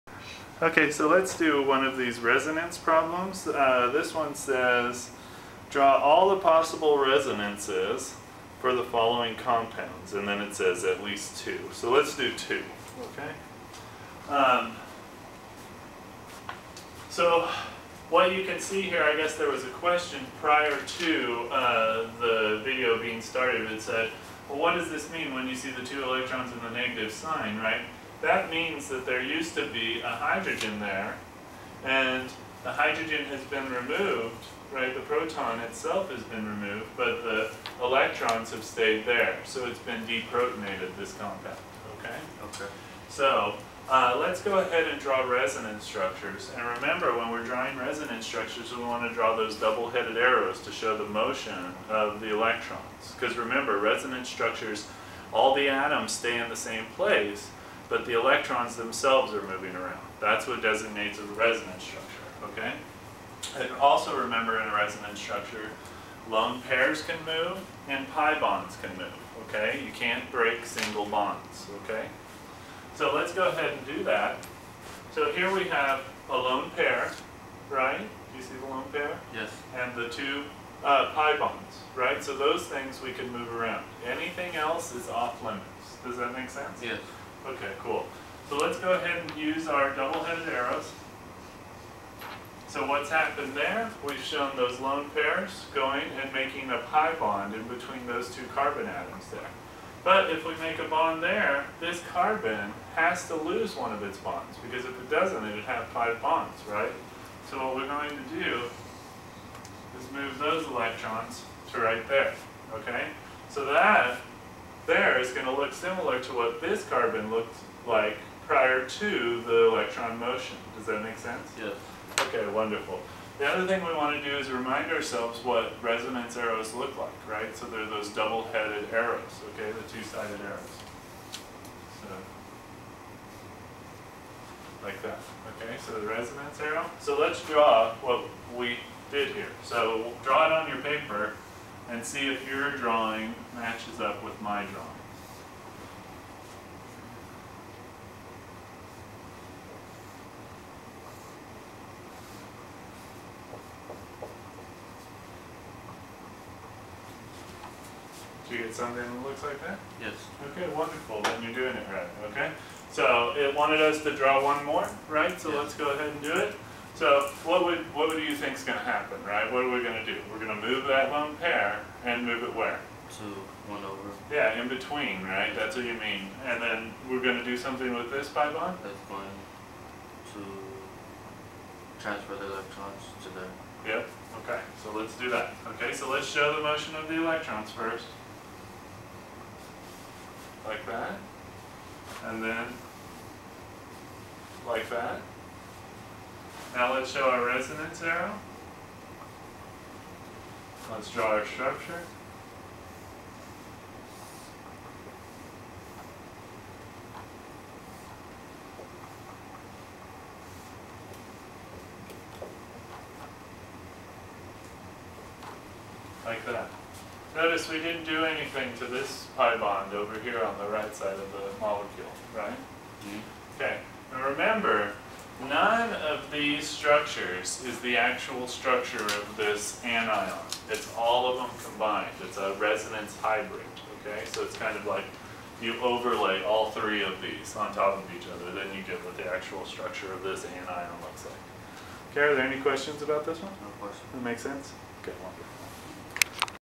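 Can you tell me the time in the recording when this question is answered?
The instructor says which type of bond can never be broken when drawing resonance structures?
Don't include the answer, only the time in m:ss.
1:10.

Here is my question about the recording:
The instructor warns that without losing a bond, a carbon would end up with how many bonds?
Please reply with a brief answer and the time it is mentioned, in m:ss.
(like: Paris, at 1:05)
5, at 1:45.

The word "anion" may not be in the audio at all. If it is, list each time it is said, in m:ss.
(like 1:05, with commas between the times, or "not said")
3:49, 4:00.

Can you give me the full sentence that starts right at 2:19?
So draw it on your paper and see if your drawing matches up with my drawing.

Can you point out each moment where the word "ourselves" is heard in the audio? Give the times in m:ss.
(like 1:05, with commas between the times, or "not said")
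2:04.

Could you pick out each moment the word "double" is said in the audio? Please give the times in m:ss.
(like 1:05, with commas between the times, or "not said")
0:49, 1:29, 2:08.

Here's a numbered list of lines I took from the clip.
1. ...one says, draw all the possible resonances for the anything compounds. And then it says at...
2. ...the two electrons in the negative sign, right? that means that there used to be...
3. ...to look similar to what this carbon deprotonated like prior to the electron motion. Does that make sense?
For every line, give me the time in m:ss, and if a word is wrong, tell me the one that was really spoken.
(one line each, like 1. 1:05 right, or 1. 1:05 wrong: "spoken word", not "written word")
1. 0:04 wrong: "following", not "anything"
2. 0:25 right
3. 1:55 wrong: "looked", not "deprotonated".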